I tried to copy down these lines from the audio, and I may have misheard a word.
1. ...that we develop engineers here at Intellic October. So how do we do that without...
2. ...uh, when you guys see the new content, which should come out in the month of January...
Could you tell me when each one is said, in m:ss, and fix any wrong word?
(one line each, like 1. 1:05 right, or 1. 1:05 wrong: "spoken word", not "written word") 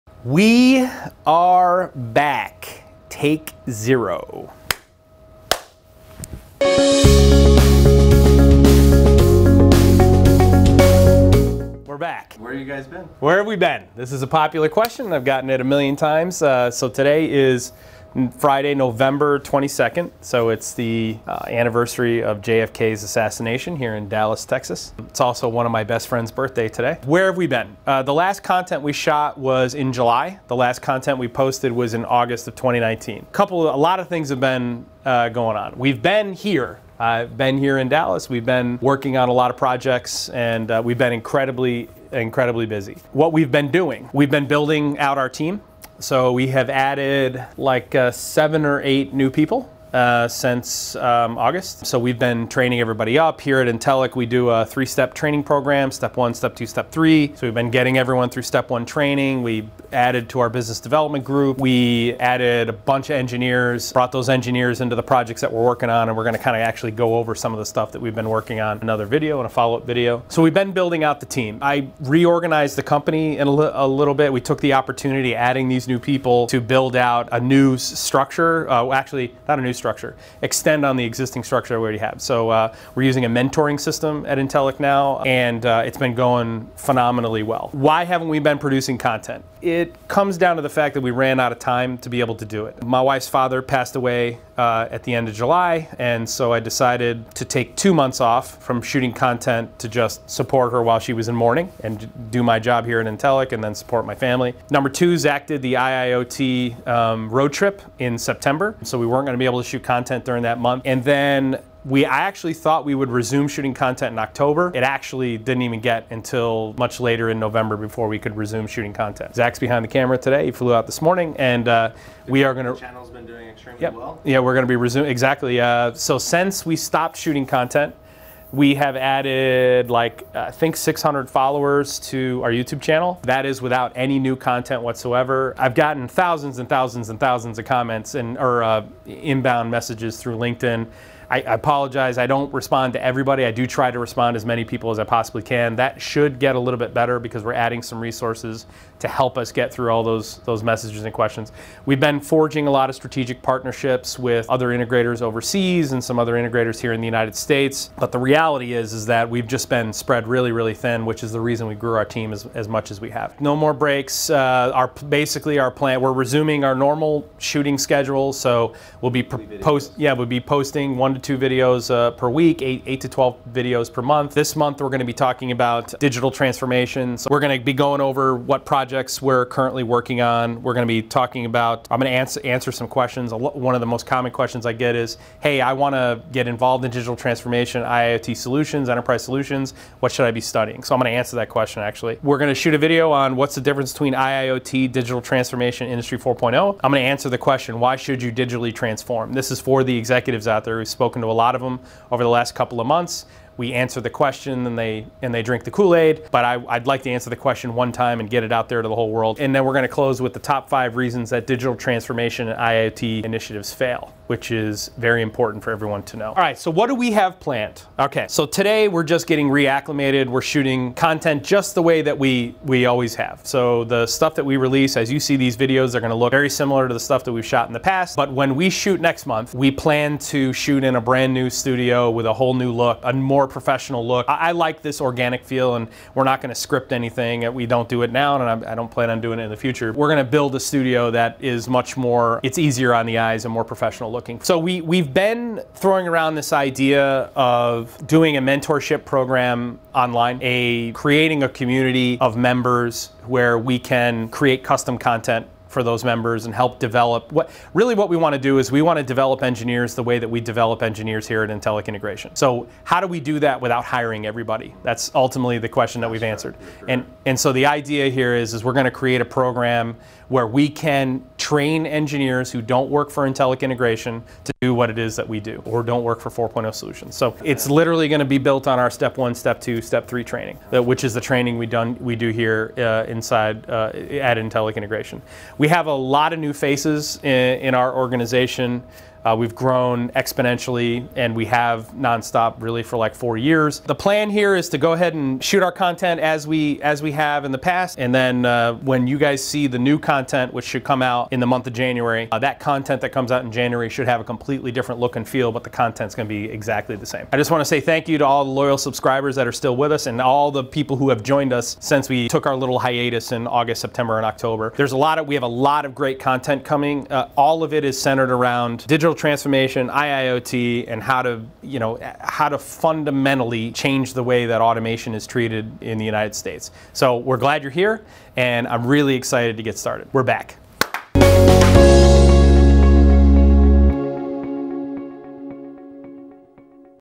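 1. 4:20 wrong: "Integration", not "October"
2. 4:58 right.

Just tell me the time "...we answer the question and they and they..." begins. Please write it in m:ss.
3:23.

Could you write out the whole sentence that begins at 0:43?
What we've been doing, we've been building out our team.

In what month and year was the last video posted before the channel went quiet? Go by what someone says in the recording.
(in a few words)
August 2019.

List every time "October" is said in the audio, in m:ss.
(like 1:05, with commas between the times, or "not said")
1:54, 5:14.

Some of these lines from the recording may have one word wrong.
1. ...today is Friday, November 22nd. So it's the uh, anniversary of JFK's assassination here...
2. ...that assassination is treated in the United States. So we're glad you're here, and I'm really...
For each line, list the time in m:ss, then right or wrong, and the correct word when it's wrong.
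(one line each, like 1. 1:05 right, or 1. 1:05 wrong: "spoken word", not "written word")
1. 0:16 right
2. 5:24 wrong: "automation", not "assassination".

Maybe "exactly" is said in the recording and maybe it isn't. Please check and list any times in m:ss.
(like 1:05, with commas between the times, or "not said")
2:05, 5:06.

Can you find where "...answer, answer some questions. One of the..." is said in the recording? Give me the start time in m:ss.
3:02.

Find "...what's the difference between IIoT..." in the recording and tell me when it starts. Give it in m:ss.
3:13.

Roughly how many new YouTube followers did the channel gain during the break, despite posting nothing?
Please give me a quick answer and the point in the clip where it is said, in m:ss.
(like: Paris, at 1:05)
600, at 2:10.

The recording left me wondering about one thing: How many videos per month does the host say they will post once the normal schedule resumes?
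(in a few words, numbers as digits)
8 to 12.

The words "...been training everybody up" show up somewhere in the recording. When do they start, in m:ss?
0:52.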